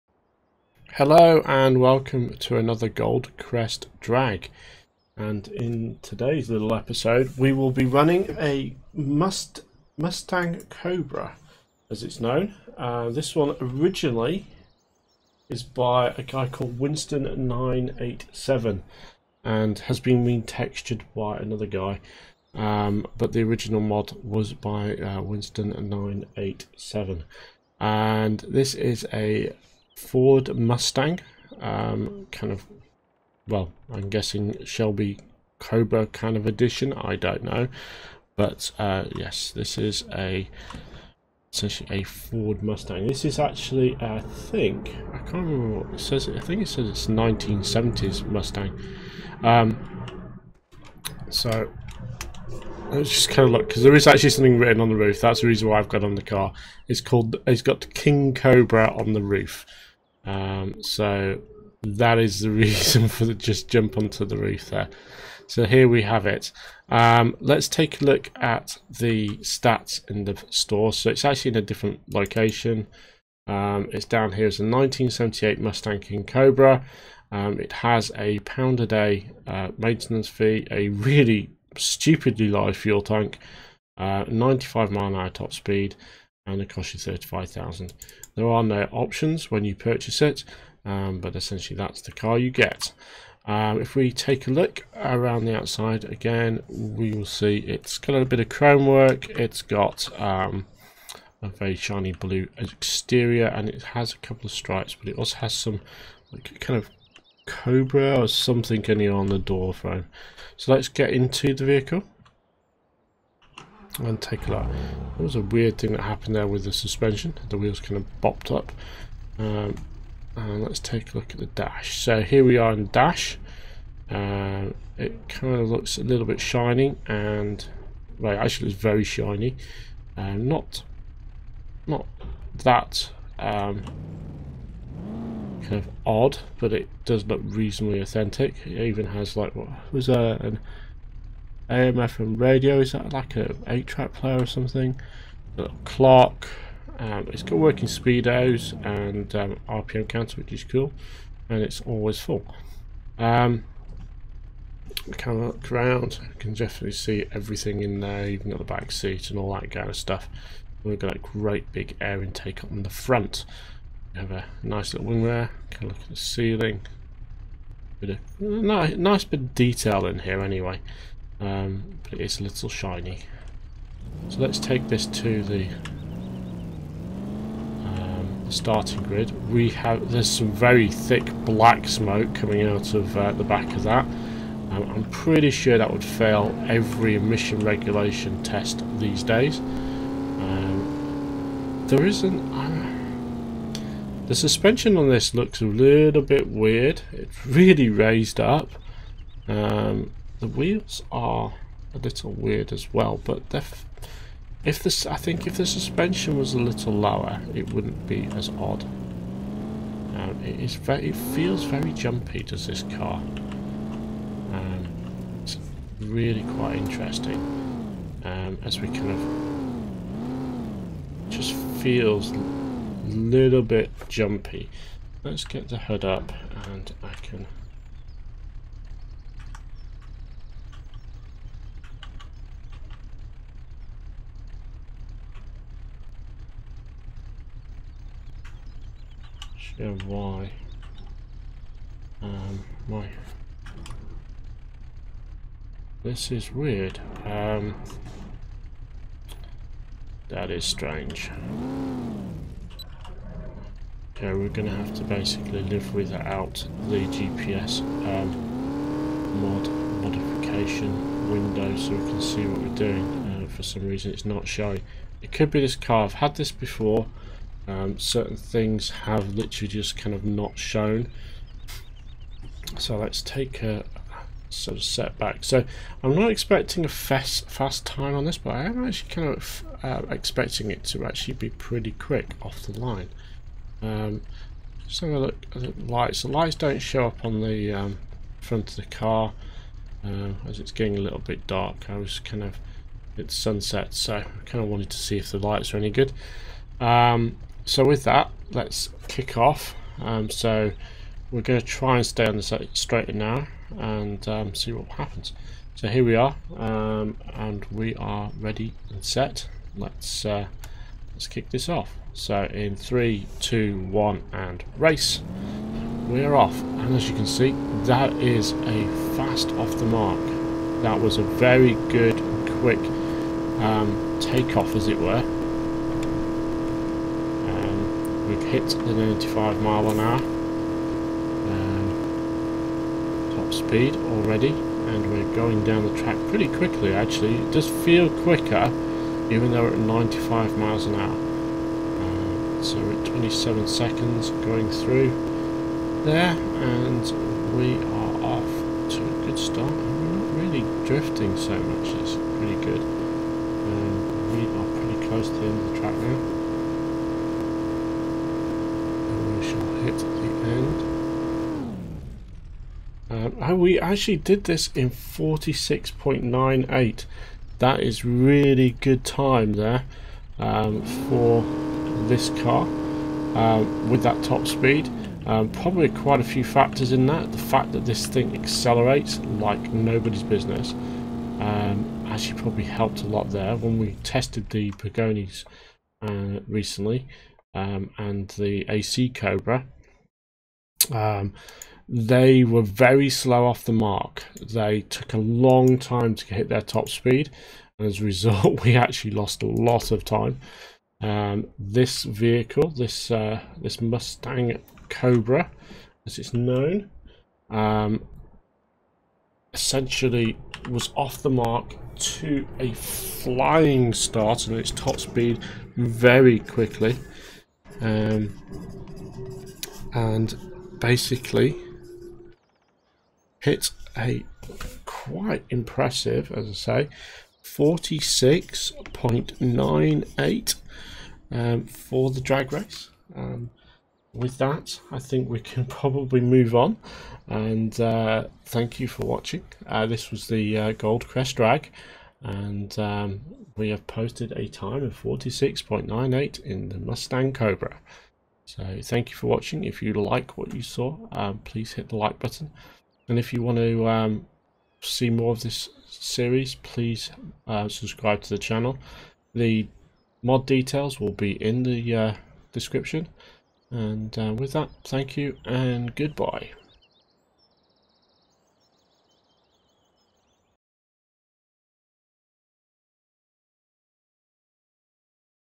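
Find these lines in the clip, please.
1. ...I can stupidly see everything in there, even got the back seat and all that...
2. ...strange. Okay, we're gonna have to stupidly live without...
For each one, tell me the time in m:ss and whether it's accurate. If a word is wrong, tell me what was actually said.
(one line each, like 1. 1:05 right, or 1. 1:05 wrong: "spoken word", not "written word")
1. 2:36 wrong: "definitely", not "stupidly"
2. 4:10 wrong: "basically", not "stupidly".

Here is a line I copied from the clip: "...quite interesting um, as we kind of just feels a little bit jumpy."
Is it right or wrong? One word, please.
right.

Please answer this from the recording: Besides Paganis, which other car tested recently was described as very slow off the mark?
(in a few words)
AC Cobra.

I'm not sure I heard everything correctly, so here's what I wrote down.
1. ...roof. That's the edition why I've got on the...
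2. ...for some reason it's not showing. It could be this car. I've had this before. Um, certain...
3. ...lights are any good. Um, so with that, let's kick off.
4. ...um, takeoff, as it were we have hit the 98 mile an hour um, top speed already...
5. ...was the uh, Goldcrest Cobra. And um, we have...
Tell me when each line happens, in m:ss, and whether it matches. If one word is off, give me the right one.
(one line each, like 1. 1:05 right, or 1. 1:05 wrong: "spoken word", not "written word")
1. 0:54 wrong: "reason", not "edition"
2. 4:23 right
3. 4:55 right
4. 5:23 wrong: "95", not "98"
5. 7:20 wrong: "Drag", not "Cobra".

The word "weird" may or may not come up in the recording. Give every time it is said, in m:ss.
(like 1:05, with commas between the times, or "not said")
1:55, 3:16, 3:22, 4:06.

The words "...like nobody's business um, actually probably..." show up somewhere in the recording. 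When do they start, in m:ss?
6:19.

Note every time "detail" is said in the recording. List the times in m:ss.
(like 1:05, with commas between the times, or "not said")
2:49, 7:40.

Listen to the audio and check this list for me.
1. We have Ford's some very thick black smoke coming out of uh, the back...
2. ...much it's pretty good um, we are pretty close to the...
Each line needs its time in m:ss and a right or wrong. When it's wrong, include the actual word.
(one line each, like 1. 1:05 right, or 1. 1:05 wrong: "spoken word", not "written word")
1. 2:59 wrong: "There", not "Ford"
2. 5:51 right.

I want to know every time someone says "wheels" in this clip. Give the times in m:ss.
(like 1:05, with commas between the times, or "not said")
1:57, 3:20.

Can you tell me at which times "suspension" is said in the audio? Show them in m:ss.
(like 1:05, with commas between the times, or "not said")
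1:56, 3:14, 3:25.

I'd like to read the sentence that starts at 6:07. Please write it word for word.
That is really good time there um, for this car um, with that top speed.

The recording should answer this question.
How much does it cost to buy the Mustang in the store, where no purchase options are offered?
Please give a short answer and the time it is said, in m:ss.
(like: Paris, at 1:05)
35,000, at 1:26.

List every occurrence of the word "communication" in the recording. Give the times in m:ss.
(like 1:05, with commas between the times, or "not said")
not said.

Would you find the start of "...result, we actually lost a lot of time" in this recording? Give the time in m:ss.
6:38.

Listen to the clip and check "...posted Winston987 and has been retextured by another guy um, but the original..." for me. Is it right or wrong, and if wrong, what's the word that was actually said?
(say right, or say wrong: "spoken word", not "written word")
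wrong: "called", not "posted".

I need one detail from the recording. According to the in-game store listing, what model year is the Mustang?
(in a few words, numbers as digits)
1978.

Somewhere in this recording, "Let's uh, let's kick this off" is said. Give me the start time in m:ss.
5:09.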